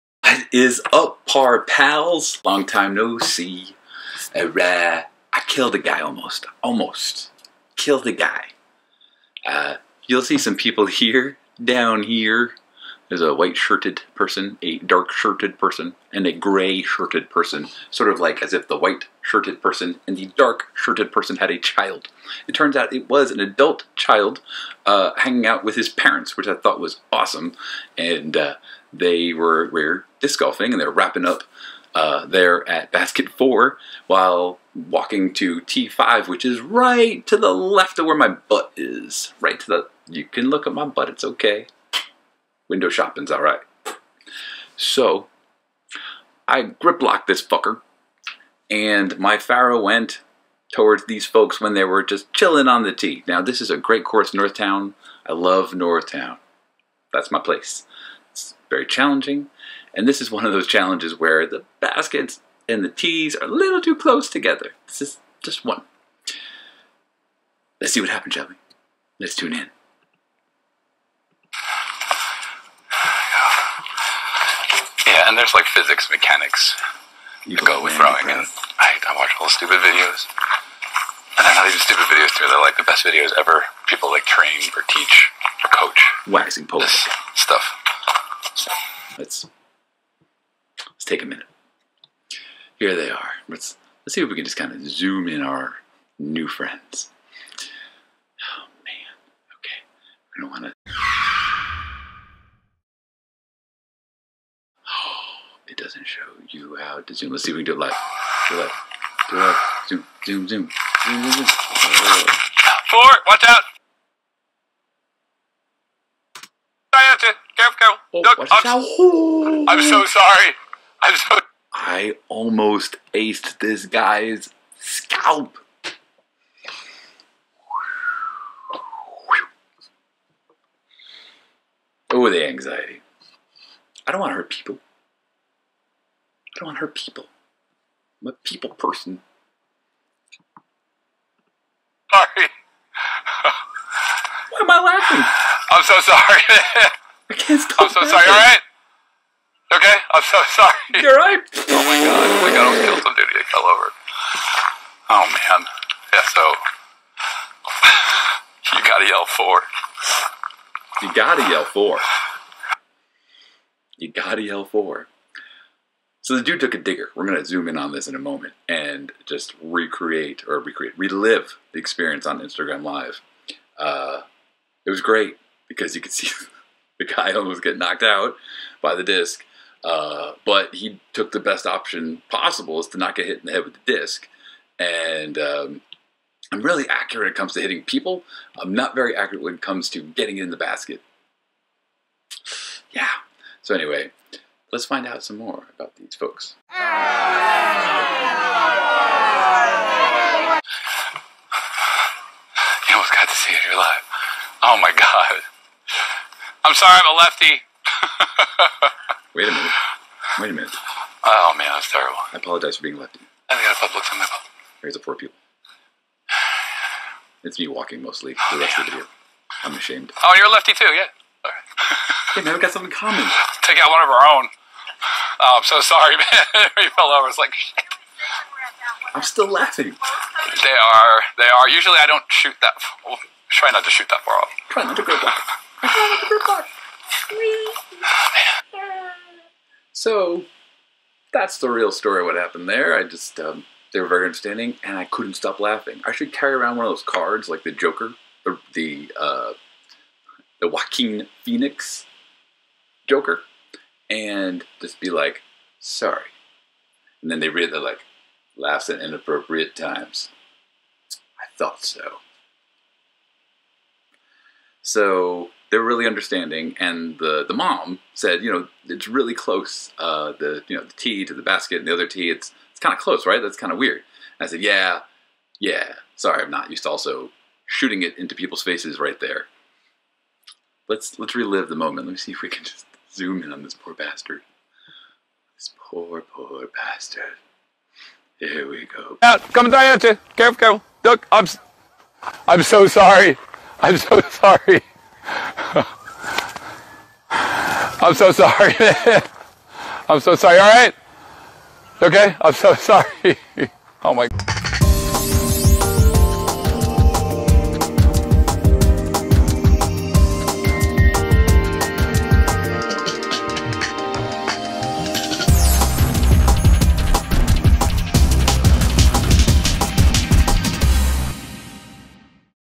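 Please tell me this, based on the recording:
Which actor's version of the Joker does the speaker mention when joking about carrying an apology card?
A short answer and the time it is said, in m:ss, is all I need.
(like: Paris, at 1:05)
Joaquin Phoenix, at 4:10.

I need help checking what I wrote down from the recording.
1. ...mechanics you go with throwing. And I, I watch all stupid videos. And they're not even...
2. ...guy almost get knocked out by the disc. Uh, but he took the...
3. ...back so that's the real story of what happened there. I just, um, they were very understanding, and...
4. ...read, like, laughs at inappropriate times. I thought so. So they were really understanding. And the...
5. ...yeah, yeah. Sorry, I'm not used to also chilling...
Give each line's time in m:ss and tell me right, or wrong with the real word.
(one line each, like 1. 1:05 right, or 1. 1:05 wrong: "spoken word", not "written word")
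1. 1:16 right
2. 2:57 right
3. 3:55 right
4. 4:17 right
5. 4:34 wrong: "shooting", not "chilling".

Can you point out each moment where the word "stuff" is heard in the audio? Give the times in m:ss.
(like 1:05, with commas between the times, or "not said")
1:27.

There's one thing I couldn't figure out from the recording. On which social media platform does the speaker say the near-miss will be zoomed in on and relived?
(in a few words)
Instagram.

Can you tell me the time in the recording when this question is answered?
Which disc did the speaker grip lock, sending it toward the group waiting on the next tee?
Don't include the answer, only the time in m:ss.
0:49.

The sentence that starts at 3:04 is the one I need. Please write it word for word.
And um, I'm really accurate when it comes to hitting people.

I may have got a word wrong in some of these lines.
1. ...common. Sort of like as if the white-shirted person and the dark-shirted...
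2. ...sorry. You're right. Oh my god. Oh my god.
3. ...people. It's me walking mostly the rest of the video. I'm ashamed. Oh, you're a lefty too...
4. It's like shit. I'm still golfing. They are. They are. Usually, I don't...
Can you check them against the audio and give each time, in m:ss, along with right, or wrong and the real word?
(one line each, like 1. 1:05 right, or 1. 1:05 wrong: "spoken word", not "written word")
1. 0:17 wrong: "person", not "common"
2. 2:30 right
3. 3:35 right
4. 3:47 wrong: "laughing", not "golfing".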